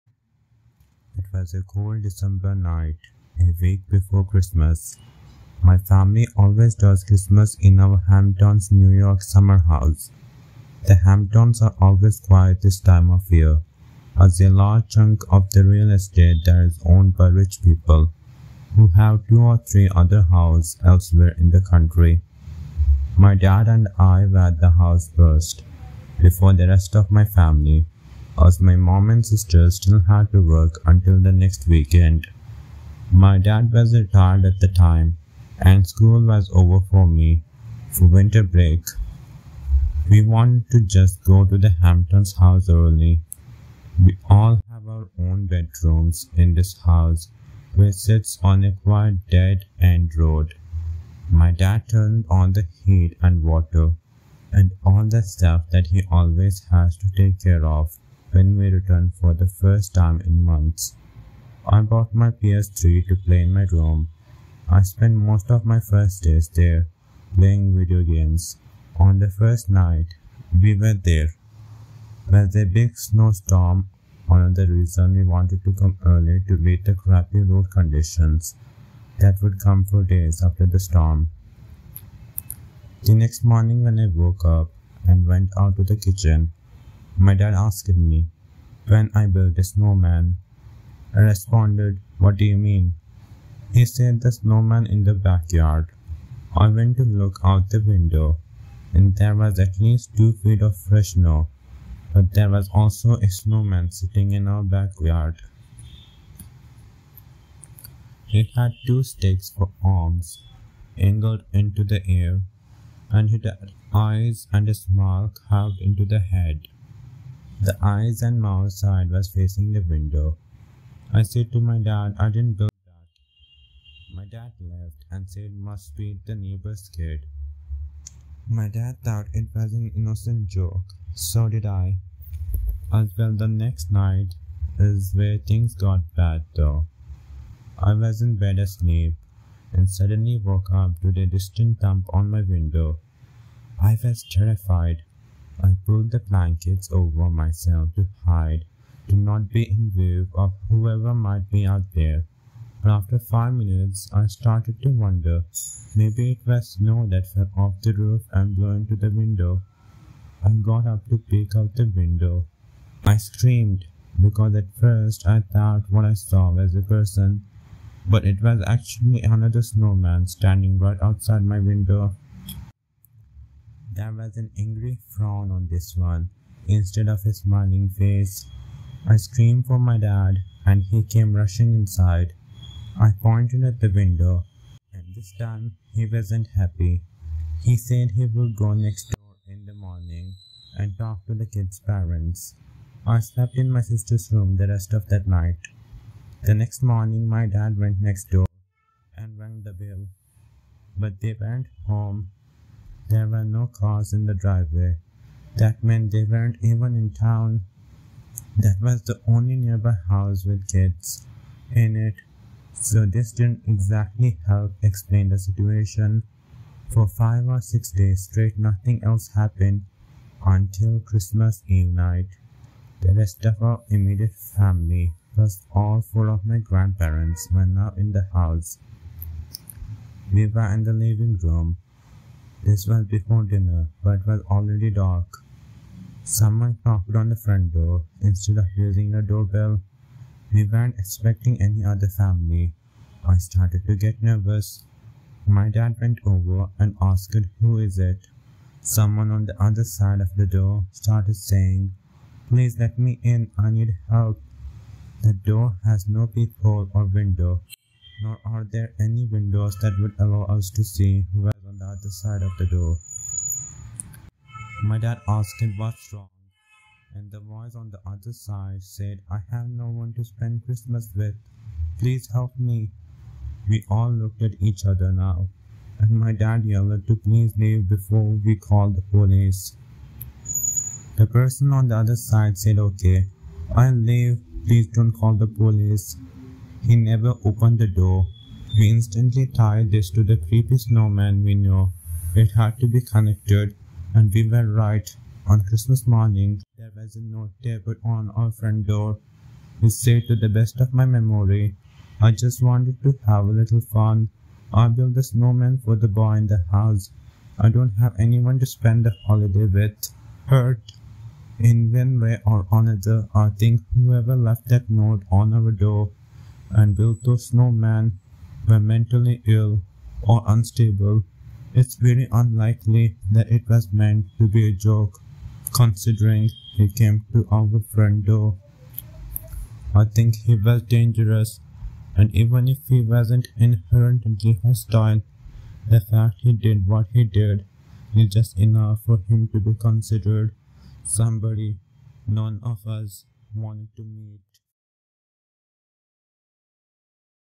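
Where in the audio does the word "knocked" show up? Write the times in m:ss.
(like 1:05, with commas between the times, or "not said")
3:56.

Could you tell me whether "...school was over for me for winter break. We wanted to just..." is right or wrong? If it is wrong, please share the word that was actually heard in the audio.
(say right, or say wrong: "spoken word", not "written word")
right.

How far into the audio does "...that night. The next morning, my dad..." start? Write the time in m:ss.
3:15.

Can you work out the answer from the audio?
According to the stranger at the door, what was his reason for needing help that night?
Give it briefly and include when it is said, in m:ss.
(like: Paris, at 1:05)
no one to spend Christmas with, at 4:29.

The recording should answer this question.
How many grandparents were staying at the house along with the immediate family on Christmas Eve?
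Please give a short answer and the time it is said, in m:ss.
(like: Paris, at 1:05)
4, at 3:45.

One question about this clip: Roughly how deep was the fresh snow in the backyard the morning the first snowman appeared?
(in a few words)
2 feet.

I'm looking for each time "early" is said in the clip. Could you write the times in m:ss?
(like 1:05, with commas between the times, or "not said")
0:42, 1:16.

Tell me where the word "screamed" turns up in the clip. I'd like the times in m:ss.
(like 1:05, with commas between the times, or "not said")
2:43, 2:59.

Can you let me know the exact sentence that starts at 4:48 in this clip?
We instantly tied this to the creepy snowman we knew.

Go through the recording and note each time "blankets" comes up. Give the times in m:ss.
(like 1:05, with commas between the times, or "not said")
2:26.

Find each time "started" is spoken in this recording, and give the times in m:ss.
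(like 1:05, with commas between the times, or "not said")
2:34, 4:03, 4:10.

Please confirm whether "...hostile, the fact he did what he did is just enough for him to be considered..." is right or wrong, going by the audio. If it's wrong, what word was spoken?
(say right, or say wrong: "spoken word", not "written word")
right.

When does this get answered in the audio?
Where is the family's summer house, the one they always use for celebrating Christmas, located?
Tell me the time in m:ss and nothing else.
0:08.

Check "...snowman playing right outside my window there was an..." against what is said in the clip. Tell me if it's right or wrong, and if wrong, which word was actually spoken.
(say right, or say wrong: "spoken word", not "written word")
wrong: "standing", not "playing".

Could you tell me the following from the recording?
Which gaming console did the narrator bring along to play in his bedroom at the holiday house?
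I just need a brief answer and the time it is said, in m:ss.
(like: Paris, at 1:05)
PS3, at 1:02.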